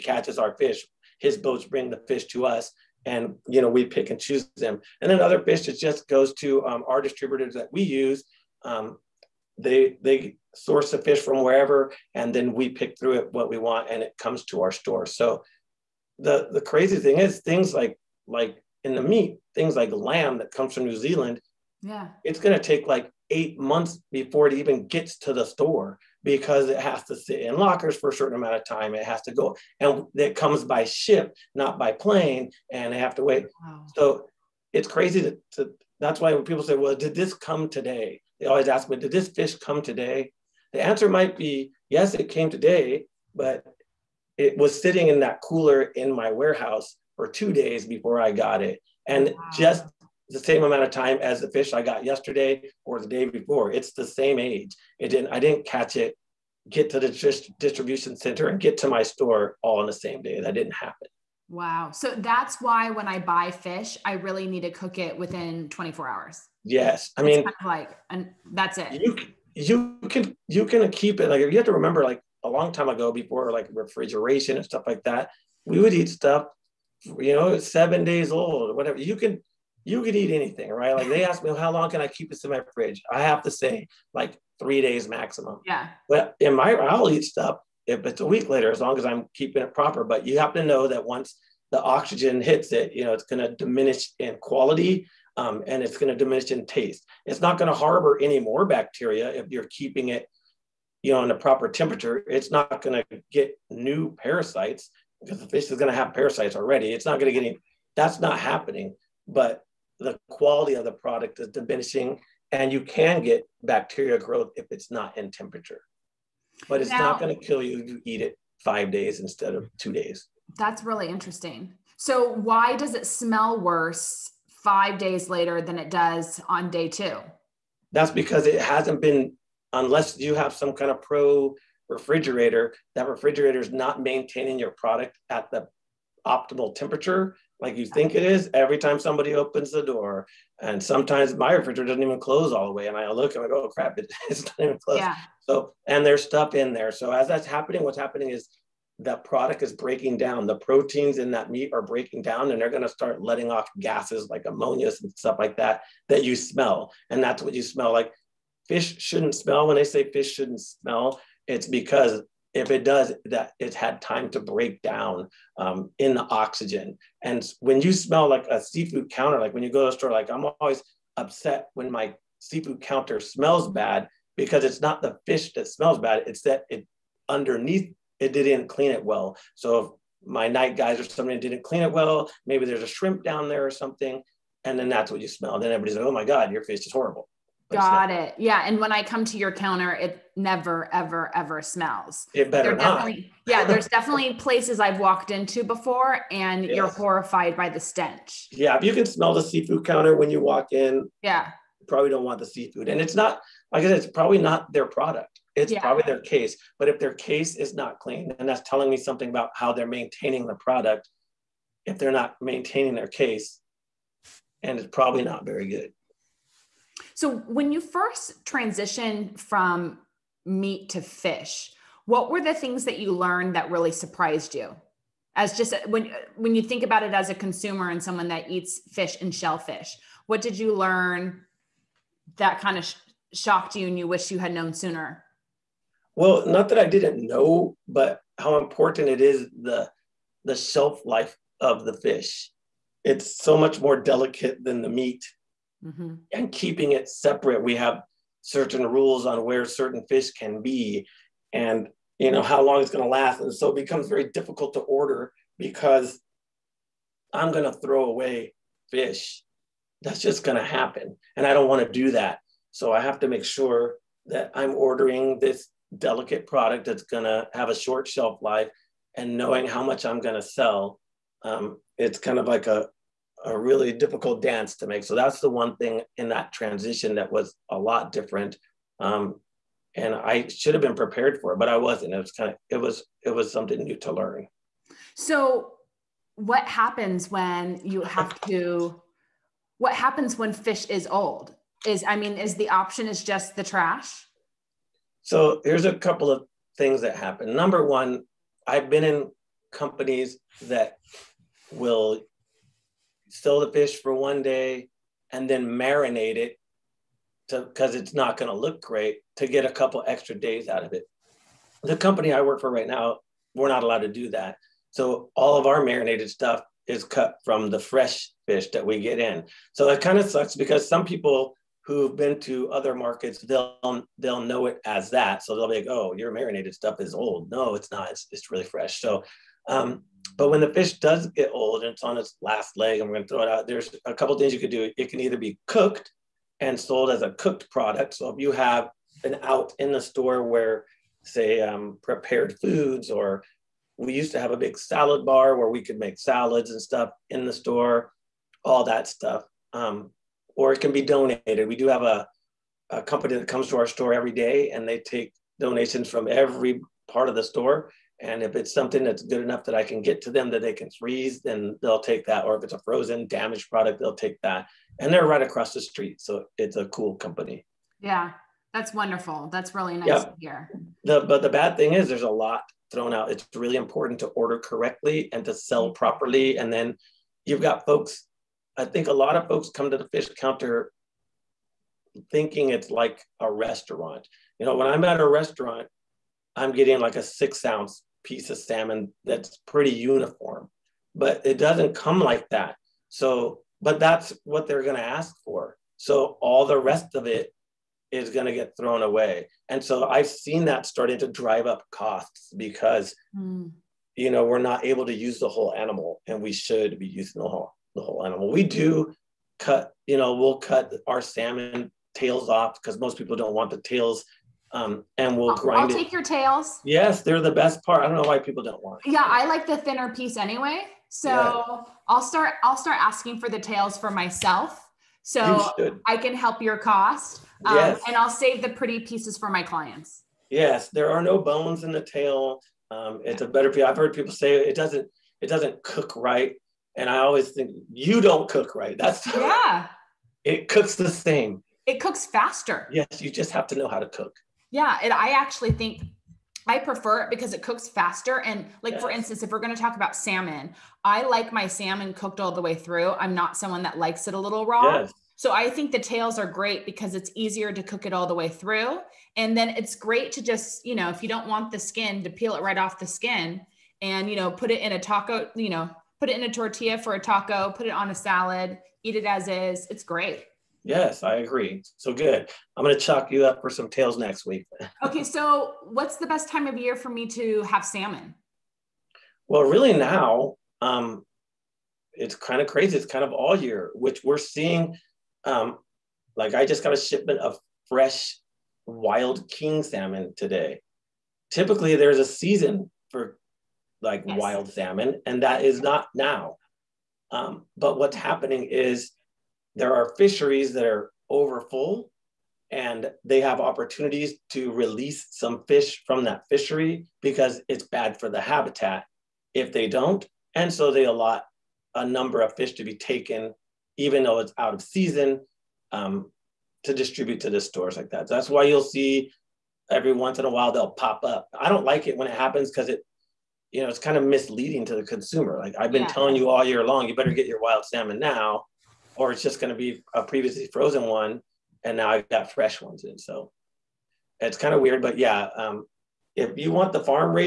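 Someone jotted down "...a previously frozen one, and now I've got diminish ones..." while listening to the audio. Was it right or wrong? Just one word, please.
wrong.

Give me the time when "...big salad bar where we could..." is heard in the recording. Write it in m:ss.
5:44.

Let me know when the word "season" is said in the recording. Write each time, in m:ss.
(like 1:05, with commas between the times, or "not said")
8:12, 8:34.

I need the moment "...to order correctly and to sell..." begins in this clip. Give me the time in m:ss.
6:14.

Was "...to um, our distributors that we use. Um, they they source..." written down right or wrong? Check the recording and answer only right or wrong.
right.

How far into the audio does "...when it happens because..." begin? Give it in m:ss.
8:42.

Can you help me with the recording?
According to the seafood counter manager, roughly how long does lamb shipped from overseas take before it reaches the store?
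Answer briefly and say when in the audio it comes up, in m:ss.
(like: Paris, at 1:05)
8 months, at 0:23.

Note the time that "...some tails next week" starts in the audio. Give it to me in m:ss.
7:53.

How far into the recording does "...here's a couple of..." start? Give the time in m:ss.
4:55.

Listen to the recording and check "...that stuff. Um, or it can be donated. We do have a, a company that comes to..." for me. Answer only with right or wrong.
right.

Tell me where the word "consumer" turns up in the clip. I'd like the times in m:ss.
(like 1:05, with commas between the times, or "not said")
3:47, 8:45.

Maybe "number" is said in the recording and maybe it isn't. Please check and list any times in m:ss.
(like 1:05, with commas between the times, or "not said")
4:57, 8:32.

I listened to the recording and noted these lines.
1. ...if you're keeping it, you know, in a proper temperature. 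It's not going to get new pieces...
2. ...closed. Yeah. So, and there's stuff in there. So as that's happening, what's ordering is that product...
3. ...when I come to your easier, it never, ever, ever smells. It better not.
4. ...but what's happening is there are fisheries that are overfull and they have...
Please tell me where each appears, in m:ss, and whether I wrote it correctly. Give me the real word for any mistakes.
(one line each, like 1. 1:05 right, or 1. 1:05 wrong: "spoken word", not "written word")
1. 1:39 wrong: "parasites", not "pieces"
2. 2:24 wrong: "happening", not "ordering"
3. 3:08 wrong: "counter", not "easier"
4. 8:17 right.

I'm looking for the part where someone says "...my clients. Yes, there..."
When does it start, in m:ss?
7:09.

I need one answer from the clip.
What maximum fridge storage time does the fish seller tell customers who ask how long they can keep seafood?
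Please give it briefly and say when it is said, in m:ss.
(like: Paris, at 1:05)
3 days maximum, at 1:24.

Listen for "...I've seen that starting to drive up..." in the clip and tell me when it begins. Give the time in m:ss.
6:40.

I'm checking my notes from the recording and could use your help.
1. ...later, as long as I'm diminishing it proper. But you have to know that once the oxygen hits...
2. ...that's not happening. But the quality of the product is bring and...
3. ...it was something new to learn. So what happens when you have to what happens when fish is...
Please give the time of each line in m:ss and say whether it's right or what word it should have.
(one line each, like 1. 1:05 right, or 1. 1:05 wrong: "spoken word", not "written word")
1. 1:28 wrong: "keeping", not "diminishing"
2. 1:47 wrong: "diminishing", not "bring"
3. 4:43 right.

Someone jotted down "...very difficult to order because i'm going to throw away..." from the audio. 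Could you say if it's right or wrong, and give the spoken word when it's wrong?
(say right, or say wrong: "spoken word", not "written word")
right.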